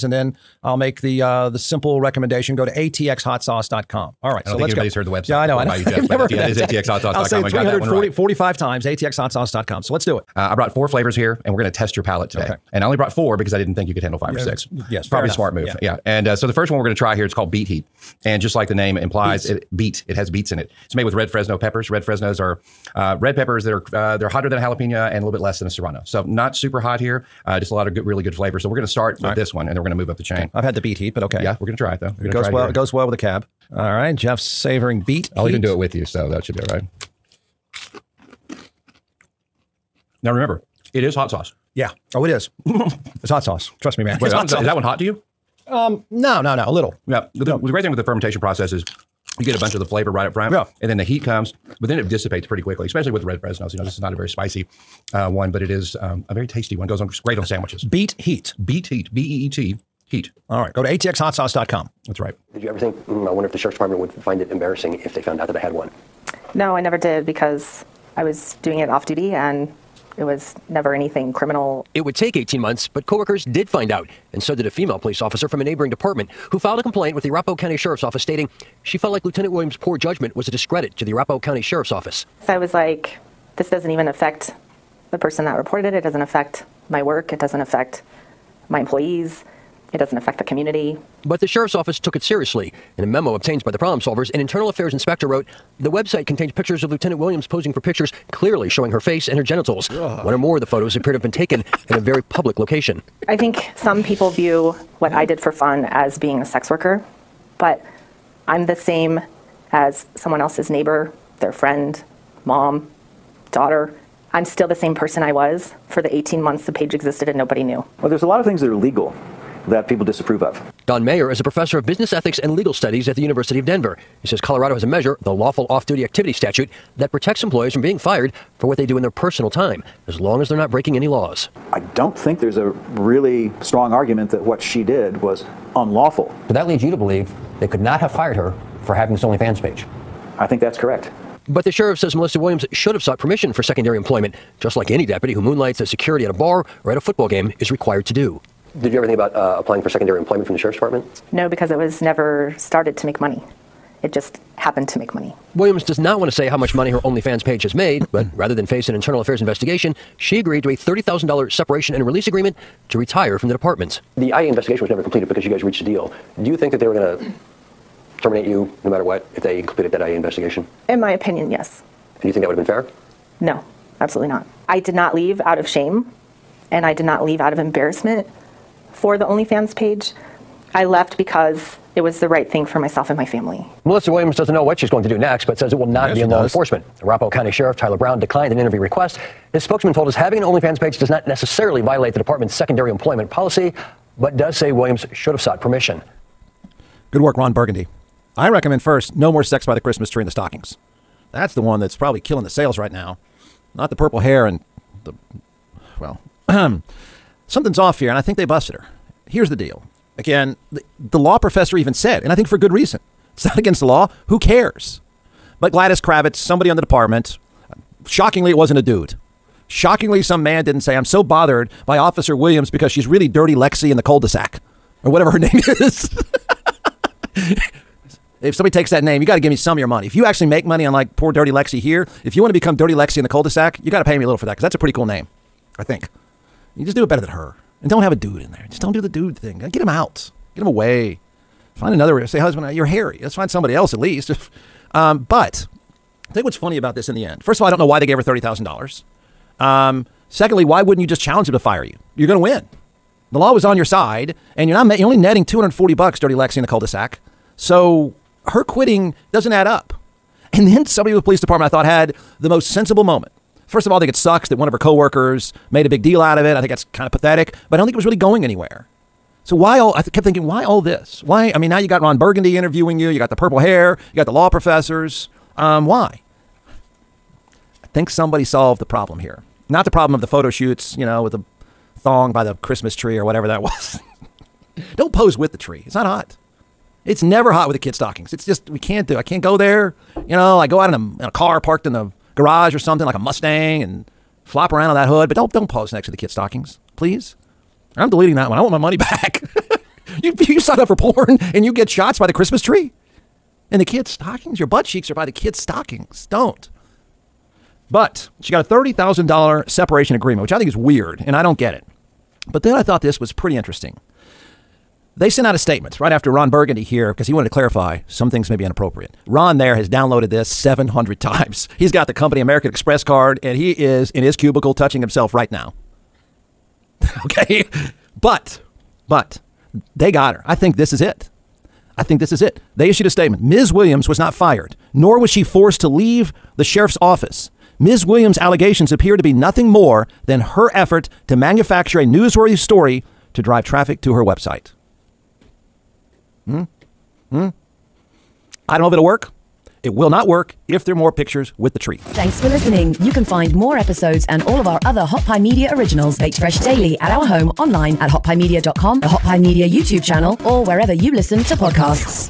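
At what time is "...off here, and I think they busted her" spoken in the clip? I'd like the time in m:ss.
3:27.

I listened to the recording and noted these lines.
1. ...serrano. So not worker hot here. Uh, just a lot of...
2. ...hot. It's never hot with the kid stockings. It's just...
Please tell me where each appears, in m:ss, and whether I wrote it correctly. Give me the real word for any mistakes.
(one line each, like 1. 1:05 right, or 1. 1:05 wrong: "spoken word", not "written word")
1. 0:25 wrong: "super", not "worker"
2. 4:46 right.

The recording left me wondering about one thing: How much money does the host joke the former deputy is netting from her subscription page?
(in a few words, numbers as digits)
$240.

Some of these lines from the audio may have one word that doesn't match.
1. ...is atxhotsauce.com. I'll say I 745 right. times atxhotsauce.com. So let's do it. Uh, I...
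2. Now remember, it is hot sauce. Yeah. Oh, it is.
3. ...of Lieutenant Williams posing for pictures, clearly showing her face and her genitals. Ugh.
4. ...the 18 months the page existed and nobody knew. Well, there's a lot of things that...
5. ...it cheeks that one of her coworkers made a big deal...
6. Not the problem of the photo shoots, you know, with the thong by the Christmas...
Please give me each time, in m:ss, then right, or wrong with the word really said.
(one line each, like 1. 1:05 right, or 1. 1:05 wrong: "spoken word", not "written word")
1. 0:06 wrong: "345", not "745"
2. 0:40 right
3. 1:36 right
4. 1:56 right
5. 4:24 wrong: "sucks", not "cheeks"
6. 4:39 right.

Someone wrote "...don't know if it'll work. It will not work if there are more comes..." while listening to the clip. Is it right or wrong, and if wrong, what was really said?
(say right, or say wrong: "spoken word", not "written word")
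wrong: "pictures", not "comes".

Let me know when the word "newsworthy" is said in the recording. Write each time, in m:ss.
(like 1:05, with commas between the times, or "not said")
5:42.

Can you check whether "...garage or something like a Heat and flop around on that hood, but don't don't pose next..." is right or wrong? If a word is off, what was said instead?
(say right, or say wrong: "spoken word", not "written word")
wrong: "Mustang", not "Heat".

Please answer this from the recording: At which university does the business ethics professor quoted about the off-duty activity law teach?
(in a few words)
University of Denver.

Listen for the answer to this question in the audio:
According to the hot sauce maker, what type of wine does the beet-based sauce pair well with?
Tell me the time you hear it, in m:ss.
0:33.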